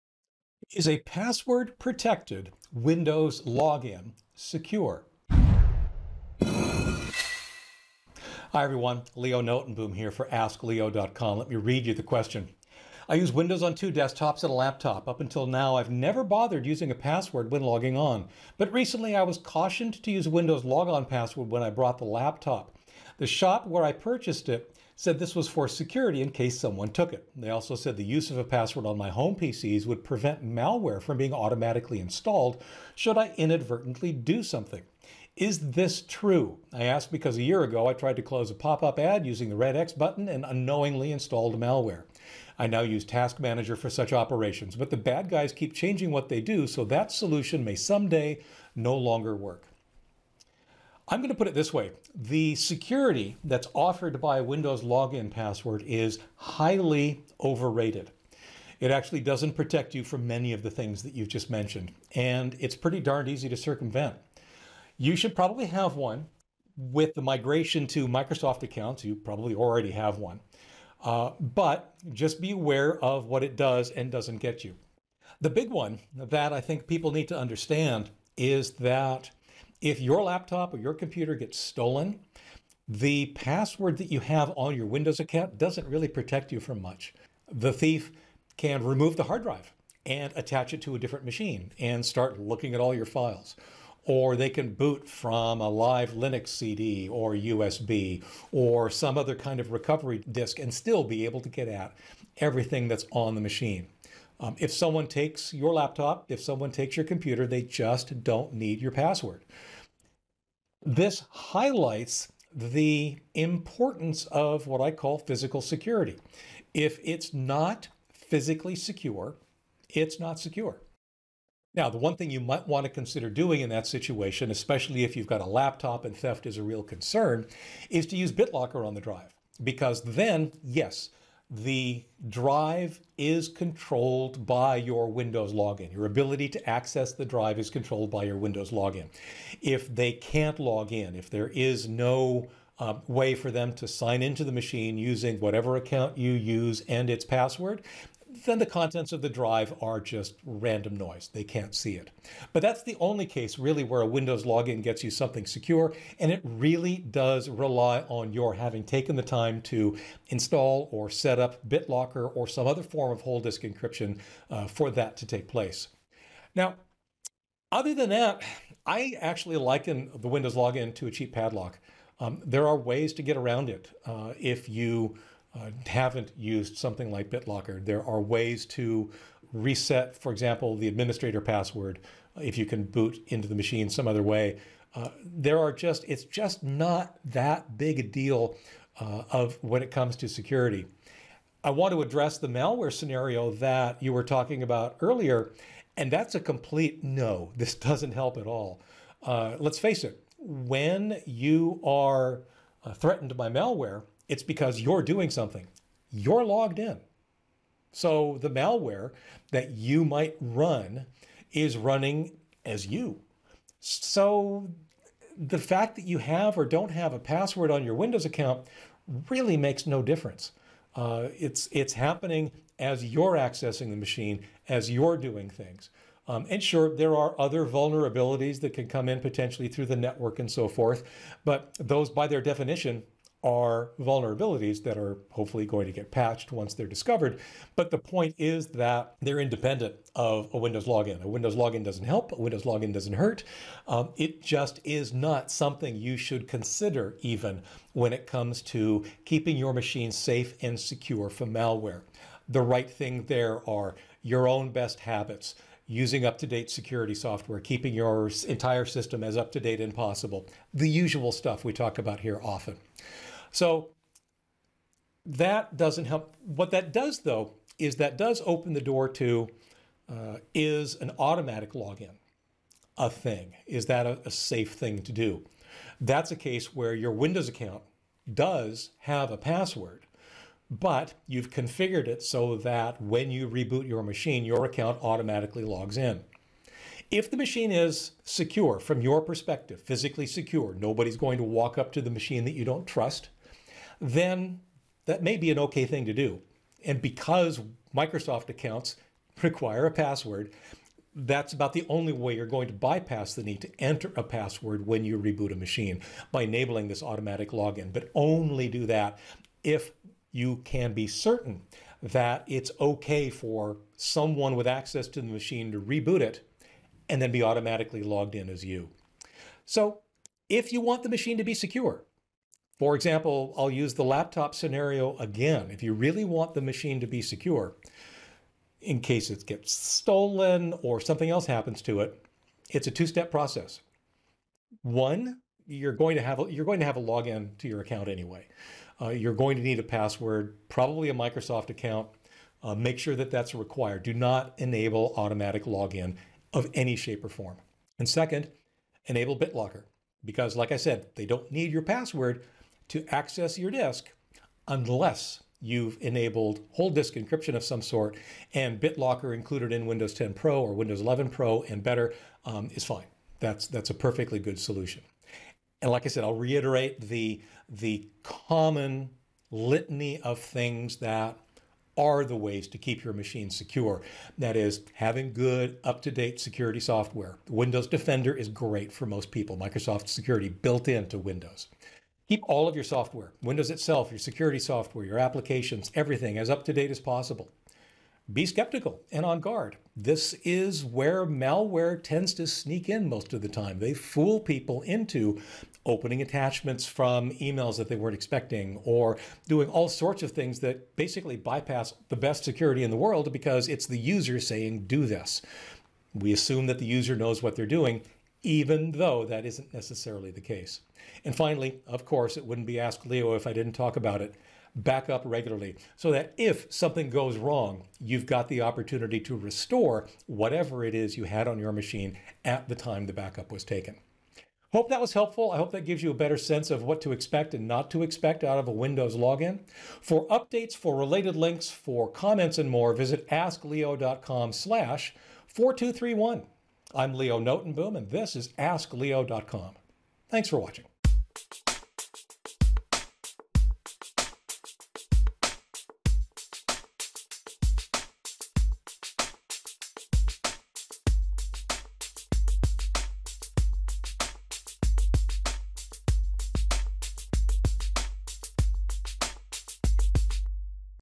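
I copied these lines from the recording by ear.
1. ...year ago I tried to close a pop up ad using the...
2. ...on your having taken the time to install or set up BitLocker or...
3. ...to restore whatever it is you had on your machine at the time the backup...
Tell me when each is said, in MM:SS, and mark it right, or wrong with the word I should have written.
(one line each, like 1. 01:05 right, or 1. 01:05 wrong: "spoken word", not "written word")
1. 00:37 right
2. 02:38 right
3. 06:59 right.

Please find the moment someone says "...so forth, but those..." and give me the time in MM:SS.
03:50.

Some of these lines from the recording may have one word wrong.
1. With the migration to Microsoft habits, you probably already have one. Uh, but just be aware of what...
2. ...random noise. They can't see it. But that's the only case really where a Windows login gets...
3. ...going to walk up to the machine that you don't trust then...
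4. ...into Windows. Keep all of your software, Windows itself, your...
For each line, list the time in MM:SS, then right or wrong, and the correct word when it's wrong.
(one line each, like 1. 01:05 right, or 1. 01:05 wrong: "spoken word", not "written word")
1. 01:06 wrong: "accounts", not "habits"
2. 02:30 right
3. 04:51 right
4. 06:20 right.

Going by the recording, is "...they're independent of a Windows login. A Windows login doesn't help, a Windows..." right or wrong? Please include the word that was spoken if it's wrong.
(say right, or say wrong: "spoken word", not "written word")
right.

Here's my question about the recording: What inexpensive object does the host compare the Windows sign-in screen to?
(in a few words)
cheap padlock.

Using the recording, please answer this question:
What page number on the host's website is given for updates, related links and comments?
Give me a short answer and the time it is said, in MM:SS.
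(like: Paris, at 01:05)
4231, at 07:15.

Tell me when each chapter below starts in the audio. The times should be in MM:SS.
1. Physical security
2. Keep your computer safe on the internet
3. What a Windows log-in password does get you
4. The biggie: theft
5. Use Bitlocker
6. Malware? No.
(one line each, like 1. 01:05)
1. 01:50
2. 04:11
3. 02:46
4. 01:15
5. 02:00
6. 03:11.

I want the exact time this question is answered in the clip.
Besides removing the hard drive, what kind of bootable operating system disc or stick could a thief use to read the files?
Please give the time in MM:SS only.
01:35.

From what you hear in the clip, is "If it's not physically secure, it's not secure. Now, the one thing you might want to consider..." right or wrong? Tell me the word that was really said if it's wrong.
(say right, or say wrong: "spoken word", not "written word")
right.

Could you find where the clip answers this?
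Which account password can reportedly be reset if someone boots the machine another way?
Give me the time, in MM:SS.
03:00.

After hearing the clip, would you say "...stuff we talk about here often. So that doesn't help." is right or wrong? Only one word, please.
right.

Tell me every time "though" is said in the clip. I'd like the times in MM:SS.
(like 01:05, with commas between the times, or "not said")
04:27, 06:48.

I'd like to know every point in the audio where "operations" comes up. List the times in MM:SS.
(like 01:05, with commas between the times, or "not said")
00:44.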